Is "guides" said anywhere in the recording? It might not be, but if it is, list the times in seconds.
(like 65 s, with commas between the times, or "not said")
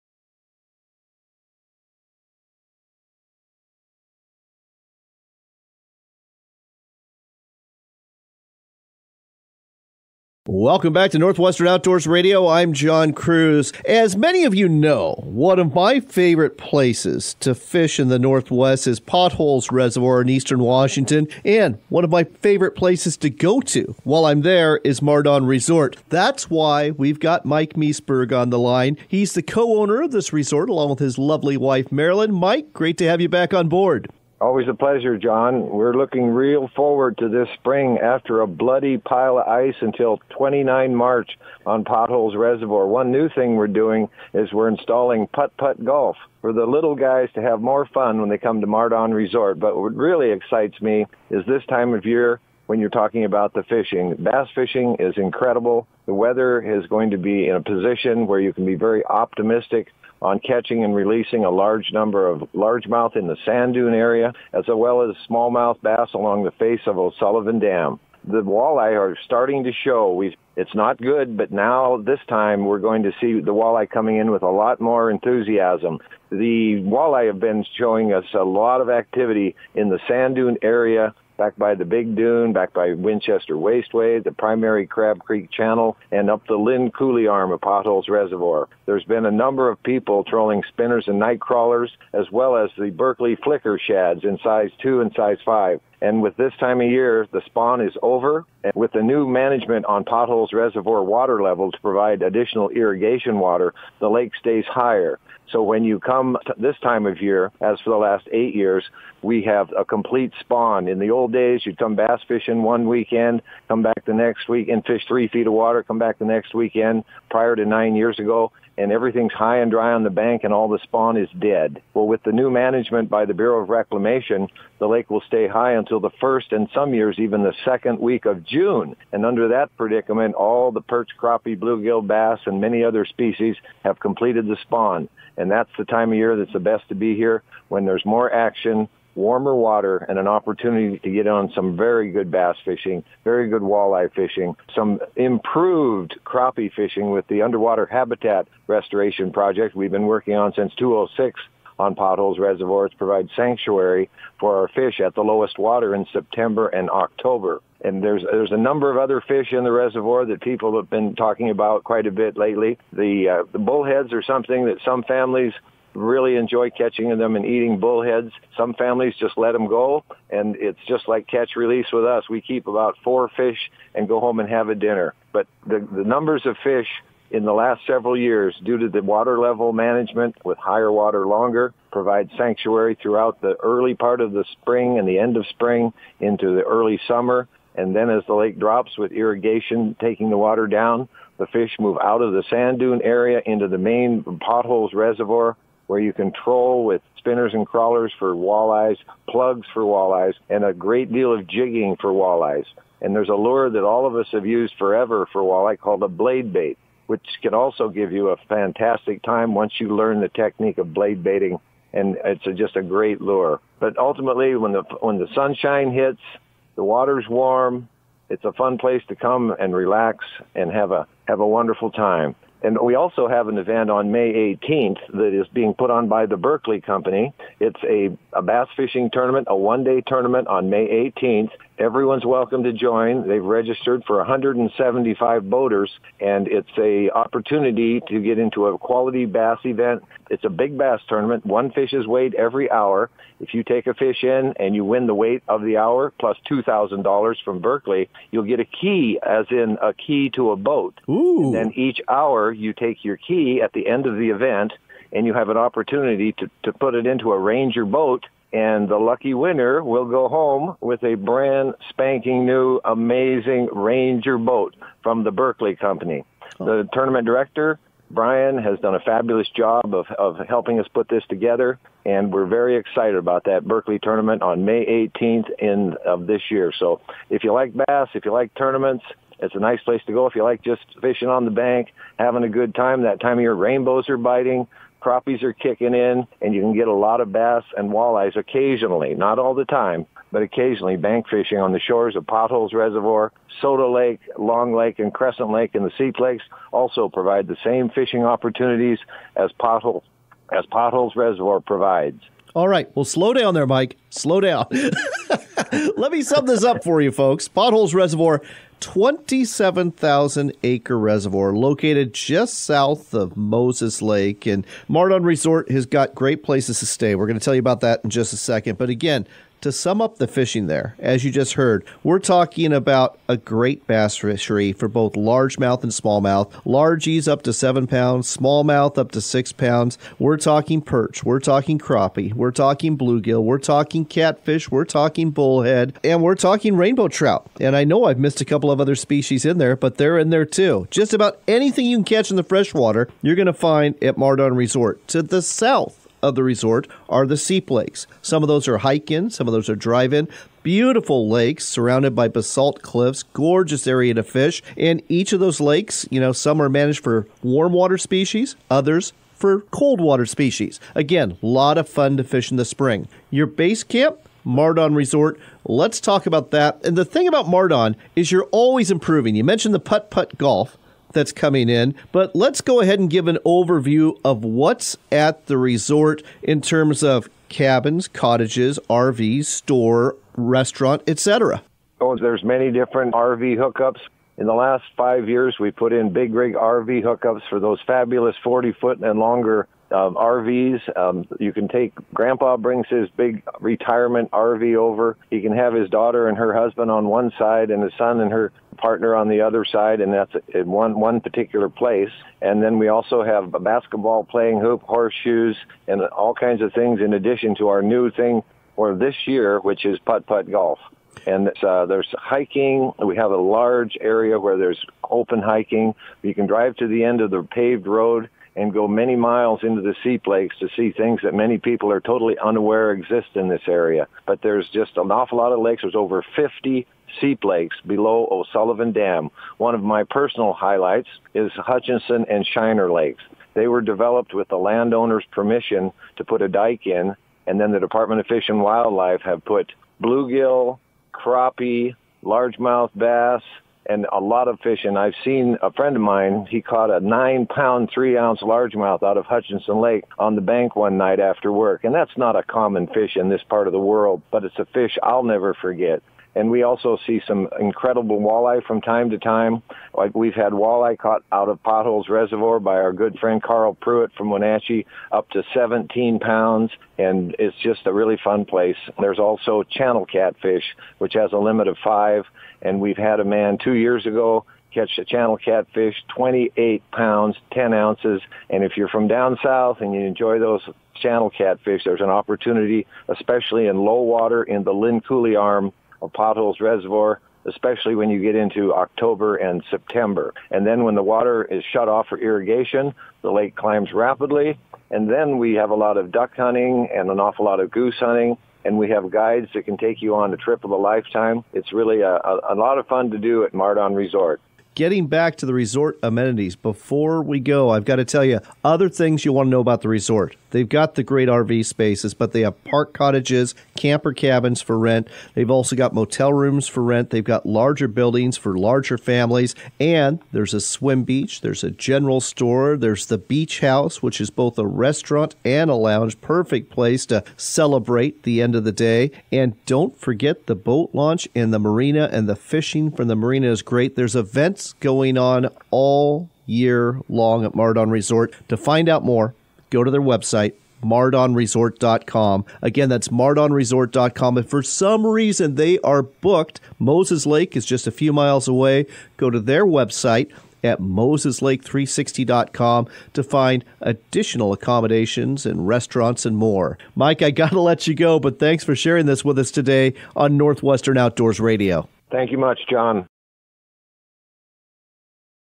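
499 s.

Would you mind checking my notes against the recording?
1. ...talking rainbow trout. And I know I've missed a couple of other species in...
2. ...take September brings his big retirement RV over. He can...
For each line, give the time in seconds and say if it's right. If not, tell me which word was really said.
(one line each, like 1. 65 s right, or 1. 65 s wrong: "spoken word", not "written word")
1. 336 s right
2. 391 s wrong: "Grandpa", not "September".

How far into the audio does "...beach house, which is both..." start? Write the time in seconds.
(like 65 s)
523 s.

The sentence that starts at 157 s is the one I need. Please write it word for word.
And there's there's a number of other fish in the reservoir that people have been talking about quite a bit lately.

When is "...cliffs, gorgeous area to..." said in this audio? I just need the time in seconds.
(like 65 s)
352 s.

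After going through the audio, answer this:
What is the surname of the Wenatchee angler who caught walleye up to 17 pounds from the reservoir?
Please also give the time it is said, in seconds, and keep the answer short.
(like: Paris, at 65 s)
Pruitt, at 463 s.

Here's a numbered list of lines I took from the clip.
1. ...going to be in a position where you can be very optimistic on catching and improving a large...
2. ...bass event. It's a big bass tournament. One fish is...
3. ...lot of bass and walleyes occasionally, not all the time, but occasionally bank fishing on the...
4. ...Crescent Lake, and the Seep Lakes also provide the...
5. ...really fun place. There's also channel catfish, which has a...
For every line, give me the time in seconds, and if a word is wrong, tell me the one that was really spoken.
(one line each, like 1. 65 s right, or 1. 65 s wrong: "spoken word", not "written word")
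1. 56 s wrong: "releasing", not "improving"
2. 239 s right
3. 286 s right
4. 295 s right
5. 467 s right.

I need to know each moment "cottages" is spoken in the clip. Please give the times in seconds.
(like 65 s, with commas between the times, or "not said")
378 s, 512 s.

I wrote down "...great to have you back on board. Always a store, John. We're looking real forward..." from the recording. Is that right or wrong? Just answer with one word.
wrong.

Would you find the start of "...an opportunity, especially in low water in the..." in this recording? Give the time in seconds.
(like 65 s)
481 s.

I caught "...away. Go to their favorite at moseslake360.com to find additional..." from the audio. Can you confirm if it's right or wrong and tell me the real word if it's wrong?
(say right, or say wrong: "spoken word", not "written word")
wrong: "website", not "favorite".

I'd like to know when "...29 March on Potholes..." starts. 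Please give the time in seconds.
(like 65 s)
40 s.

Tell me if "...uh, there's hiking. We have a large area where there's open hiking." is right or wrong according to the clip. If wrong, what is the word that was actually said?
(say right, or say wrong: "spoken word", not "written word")
right.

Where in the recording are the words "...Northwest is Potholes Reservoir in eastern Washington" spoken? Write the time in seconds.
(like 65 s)
18 s.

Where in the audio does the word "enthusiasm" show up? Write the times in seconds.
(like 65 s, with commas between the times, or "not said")
75 s.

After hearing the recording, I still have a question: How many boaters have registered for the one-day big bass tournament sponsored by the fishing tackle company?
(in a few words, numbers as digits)
175.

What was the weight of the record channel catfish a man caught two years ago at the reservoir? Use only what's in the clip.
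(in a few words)
28 pounds, 10 ounces.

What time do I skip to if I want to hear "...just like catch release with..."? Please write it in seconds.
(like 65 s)
170 s.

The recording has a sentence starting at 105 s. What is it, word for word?
So when you come this time of year, as for the last eight years, we have a complete spawn.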